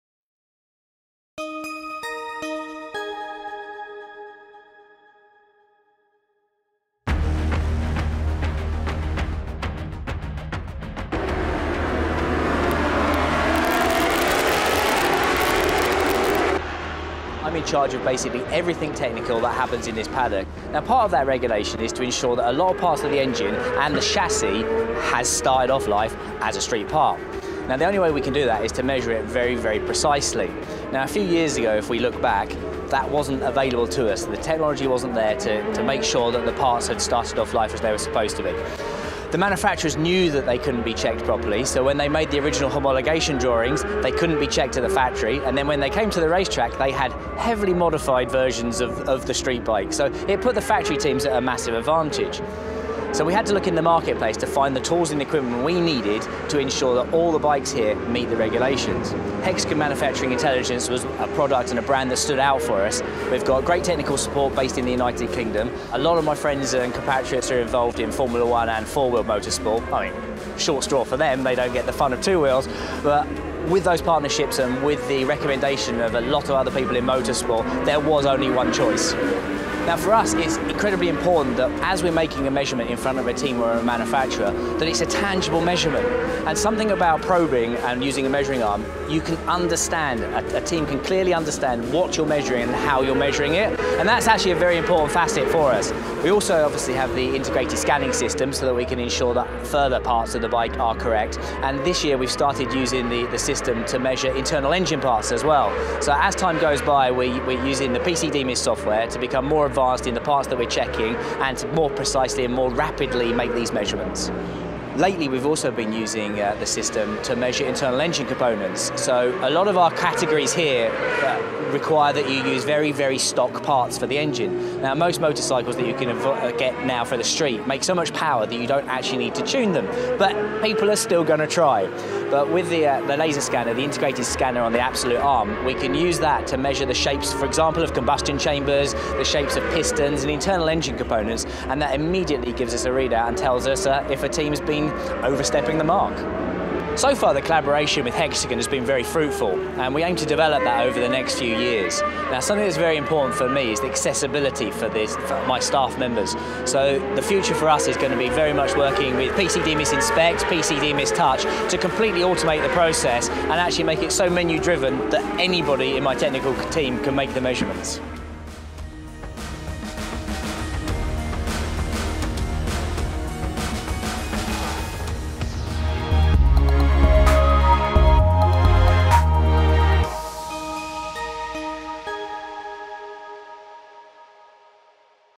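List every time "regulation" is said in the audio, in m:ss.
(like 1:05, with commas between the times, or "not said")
0:21, 0:58.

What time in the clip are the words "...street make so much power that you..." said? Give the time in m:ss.
2:07.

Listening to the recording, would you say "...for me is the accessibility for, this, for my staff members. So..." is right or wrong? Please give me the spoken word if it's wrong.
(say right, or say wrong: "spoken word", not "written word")
right.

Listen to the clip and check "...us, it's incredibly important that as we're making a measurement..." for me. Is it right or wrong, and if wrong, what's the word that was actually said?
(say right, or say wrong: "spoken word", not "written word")
right.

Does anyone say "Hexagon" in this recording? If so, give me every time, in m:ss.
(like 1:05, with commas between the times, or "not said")
0:59, 2:28.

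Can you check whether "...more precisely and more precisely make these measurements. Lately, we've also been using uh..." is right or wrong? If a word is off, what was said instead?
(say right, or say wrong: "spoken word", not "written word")
wrong: "rapidly", not "precisely".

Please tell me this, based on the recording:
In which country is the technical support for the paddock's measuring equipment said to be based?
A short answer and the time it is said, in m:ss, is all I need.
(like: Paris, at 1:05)
United Kingdom, at 1:04.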